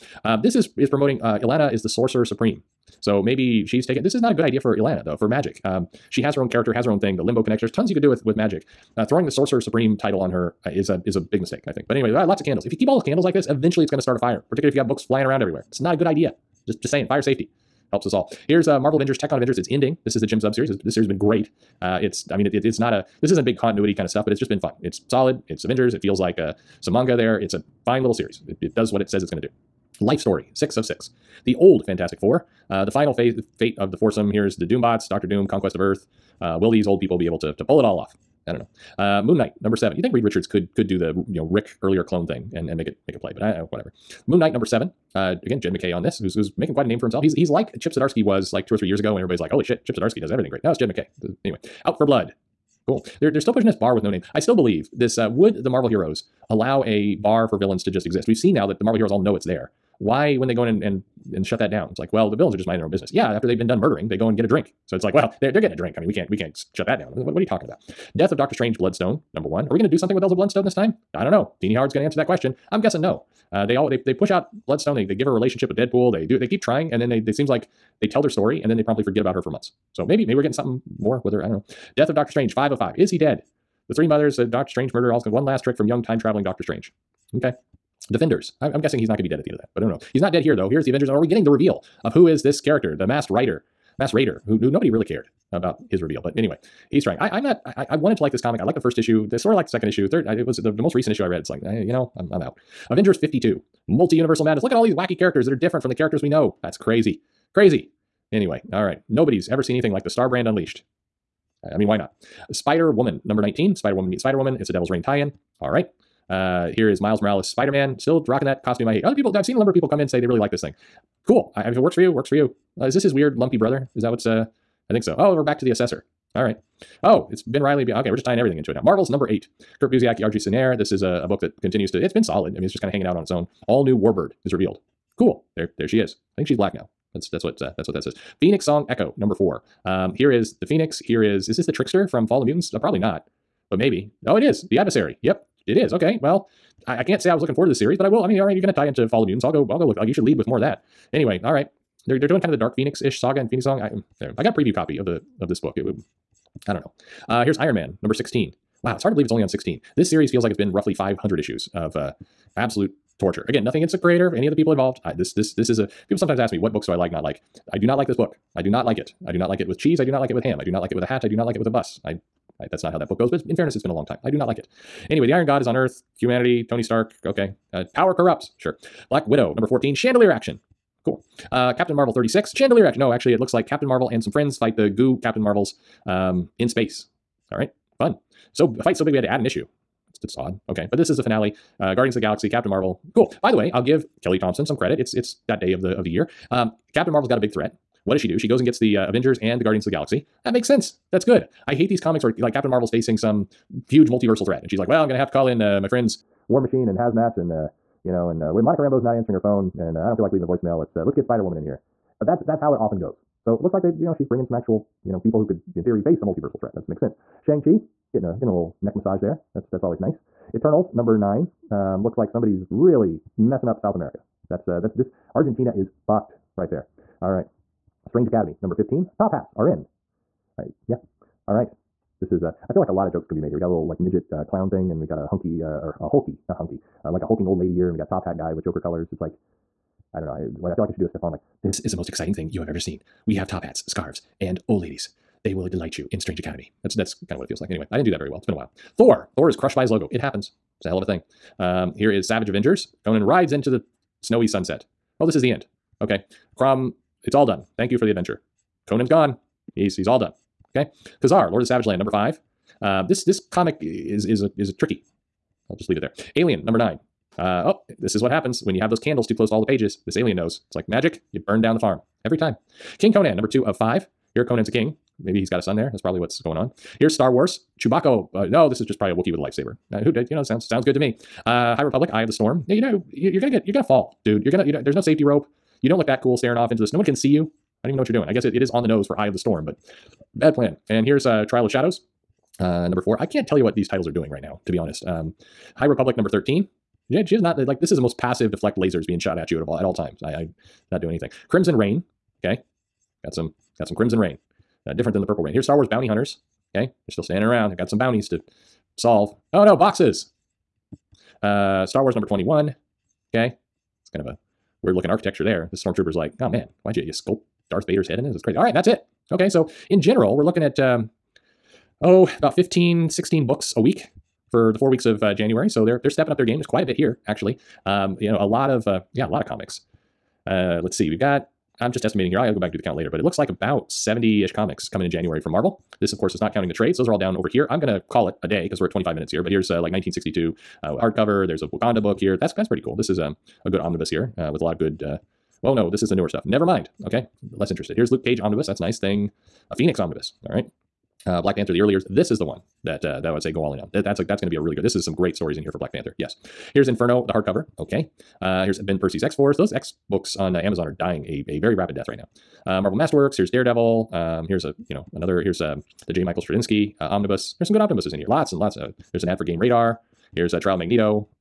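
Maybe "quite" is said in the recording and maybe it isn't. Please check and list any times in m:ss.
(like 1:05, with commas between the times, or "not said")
0:46, 5:26.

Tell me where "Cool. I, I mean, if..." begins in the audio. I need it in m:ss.
2:01.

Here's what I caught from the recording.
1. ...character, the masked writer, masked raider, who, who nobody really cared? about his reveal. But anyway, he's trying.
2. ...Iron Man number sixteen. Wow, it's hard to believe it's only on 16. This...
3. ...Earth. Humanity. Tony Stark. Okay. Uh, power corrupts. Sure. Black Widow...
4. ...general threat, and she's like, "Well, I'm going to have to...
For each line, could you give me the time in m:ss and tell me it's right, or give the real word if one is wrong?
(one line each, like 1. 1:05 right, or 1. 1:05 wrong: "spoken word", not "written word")
1. 1:32 right
2. 2:37 right
3. 2:55 right
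4. 3:24 wrong: "multiversal", not "general".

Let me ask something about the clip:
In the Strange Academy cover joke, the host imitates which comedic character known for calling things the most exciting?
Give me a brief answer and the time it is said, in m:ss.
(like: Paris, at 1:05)
Stefon, at 4:01.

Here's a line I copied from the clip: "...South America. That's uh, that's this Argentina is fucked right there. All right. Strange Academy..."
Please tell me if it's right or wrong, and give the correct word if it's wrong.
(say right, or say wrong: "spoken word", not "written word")
right.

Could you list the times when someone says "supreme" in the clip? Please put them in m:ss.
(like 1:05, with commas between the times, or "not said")
0:02, 0:09.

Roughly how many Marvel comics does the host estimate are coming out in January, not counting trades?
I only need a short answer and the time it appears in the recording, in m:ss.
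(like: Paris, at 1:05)
70, at 5:33.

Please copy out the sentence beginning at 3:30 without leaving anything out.
Let's uh, let's get Spider Woman in here." That's that's how it often goes.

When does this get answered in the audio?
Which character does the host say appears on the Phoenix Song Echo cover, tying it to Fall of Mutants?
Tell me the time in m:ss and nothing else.
2:24.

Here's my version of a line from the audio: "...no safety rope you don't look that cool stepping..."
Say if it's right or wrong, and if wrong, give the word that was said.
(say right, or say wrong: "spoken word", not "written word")
wrong: "staring", not "stepping".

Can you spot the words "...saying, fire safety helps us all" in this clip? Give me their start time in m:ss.
0:16.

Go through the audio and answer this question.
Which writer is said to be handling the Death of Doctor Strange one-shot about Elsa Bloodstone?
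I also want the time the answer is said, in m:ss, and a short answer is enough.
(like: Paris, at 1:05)
Tini Howard, at 1:11.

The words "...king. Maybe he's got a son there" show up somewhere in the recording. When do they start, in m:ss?
4:34.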